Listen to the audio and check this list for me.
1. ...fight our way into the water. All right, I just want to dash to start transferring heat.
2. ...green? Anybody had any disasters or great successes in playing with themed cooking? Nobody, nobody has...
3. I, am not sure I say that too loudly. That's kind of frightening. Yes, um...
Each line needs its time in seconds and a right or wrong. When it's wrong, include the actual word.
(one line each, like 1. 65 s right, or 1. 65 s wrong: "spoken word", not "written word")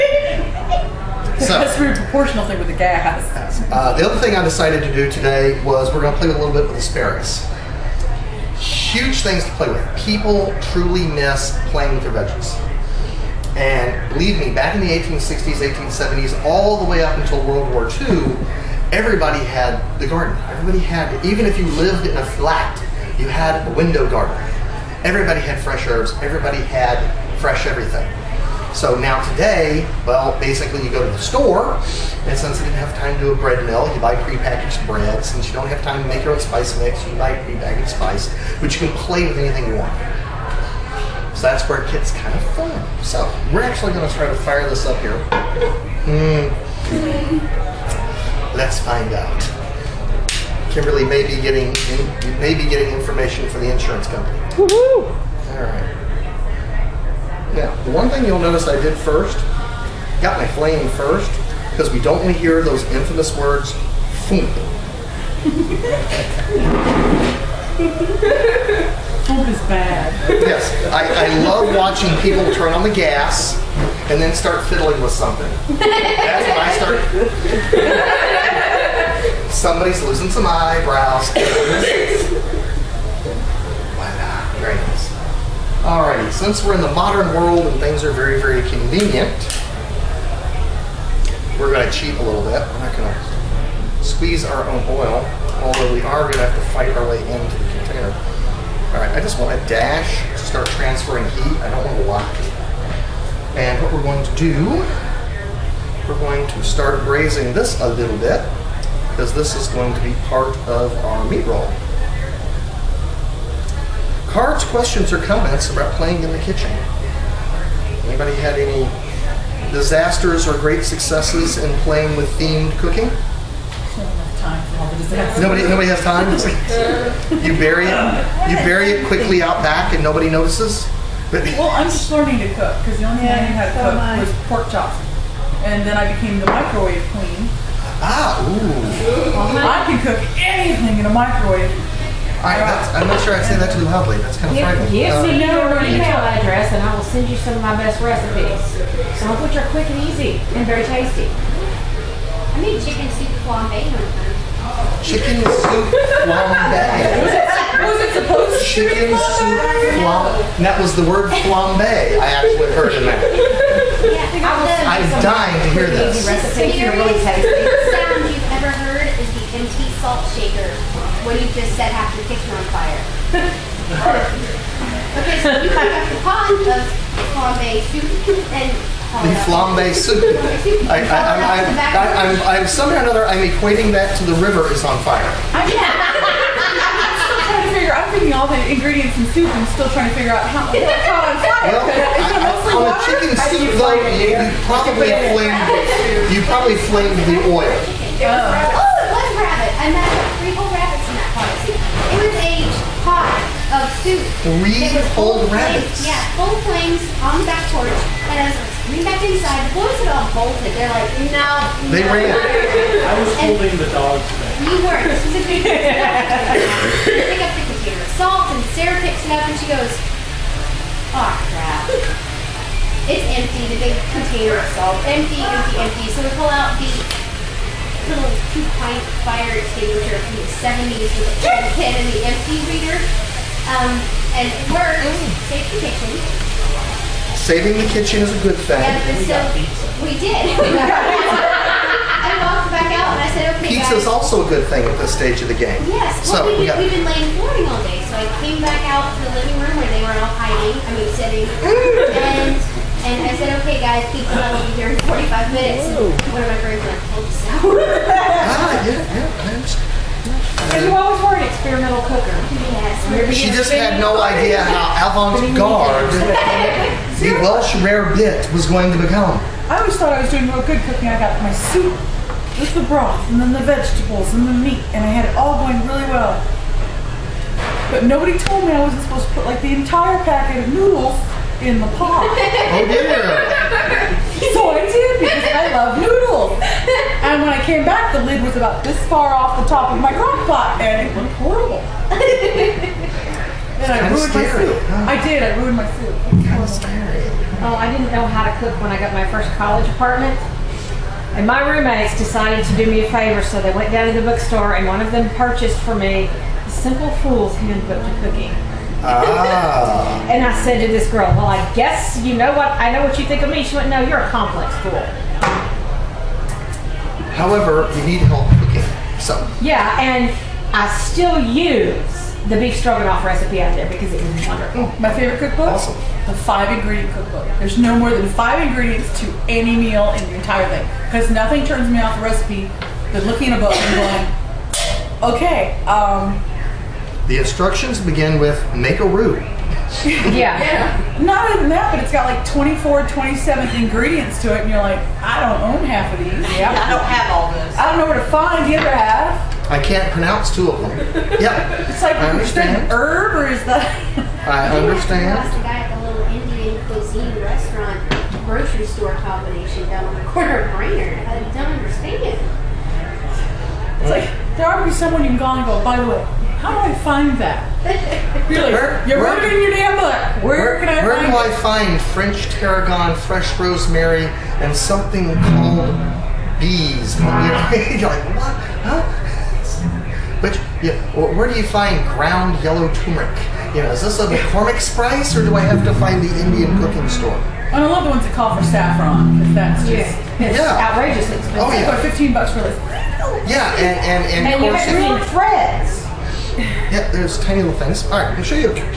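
1. 96 s wrong: "container", not "water"
2. 116 s wrong: "kitchen", not "green"
3. 142 s right.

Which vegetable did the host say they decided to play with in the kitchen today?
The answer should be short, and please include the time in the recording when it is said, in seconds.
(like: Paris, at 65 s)
asparagus, at 6 s.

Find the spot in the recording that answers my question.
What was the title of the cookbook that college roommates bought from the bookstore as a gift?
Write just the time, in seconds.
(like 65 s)
306 s.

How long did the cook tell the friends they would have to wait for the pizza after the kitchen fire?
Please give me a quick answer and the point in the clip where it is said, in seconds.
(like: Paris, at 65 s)
45 minutes, at 255 s.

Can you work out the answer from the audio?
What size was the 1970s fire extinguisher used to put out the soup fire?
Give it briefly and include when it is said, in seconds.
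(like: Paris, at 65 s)
two pint, at 228 s.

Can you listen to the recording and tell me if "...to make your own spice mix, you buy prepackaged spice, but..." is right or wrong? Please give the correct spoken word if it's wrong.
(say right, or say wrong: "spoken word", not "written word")
right.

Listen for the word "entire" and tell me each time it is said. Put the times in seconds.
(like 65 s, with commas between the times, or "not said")
279 s, 330 s.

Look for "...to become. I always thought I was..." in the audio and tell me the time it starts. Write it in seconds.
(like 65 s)
268 s.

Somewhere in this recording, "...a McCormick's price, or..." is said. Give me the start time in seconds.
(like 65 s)
384 s.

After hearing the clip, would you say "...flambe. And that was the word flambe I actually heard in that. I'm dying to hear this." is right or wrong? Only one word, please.
right.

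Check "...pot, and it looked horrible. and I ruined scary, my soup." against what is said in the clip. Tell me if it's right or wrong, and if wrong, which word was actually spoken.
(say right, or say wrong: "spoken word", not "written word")
right.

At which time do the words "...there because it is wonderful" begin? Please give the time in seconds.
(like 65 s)
323 s.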